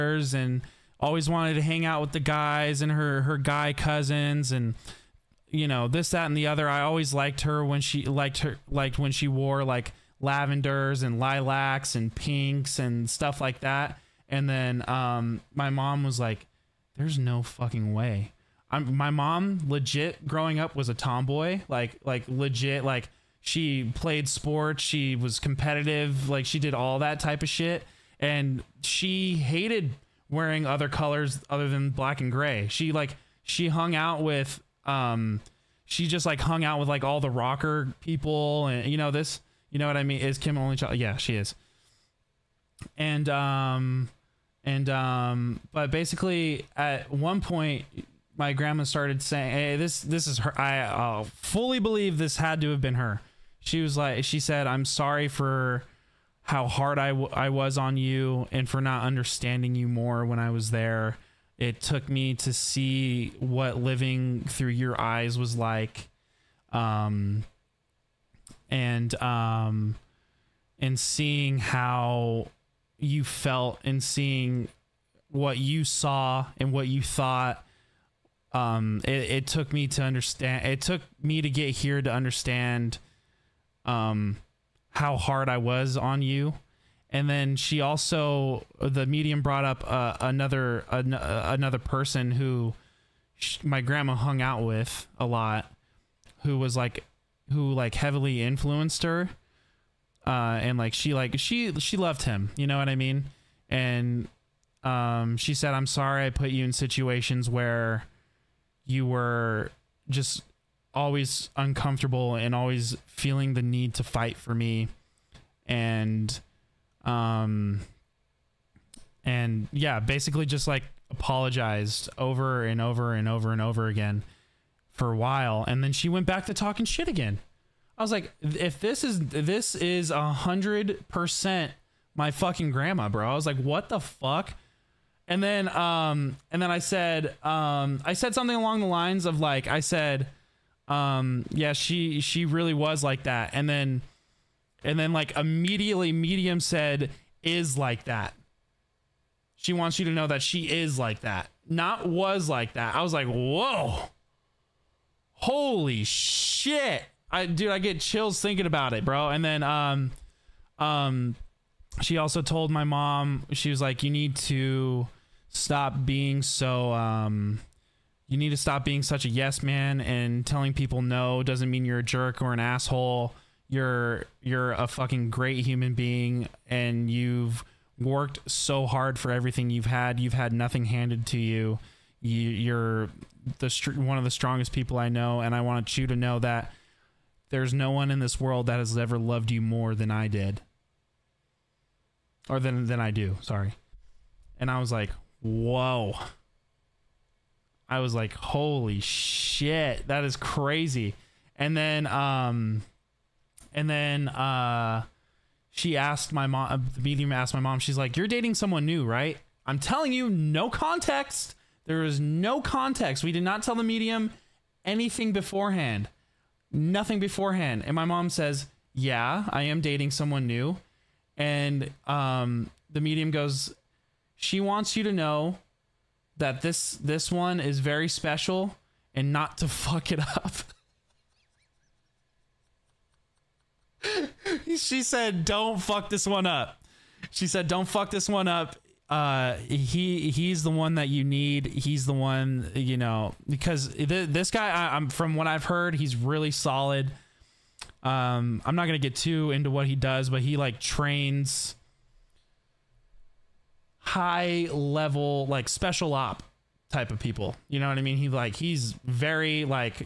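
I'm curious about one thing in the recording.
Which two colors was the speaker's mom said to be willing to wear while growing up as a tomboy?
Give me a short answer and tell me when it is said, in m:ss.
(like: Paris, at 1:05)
Black and gray, at 0:31.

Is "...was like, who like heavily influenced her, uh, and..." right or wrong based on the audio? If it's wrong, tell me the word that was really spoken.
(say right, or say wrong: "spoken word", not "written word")
right.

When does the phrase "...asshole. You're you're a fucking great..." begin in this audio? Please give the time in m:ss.
2:52.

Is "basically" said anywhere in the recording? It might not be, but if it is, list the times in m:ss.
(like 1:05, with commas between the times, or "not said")
0:45, 1:59.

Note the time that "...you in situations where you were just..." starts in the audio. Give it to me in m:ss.
1:46.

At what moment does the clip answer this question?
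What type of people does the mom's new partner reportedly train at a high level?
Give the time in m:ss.
4:15.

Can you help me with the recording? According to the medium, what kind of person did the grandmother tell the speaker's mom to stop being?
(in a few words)
A yes man.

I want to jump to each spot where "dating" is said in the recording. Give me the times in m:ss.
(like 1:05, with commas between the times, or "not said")
3:28, 3:39.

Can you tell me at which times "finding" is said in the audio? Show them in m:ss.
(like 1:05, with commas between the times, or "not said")
not said.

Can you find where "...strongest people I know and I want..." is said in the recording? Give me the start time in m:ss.
3:04.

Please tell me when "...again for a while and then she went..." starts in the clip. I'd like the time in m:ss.
2:03.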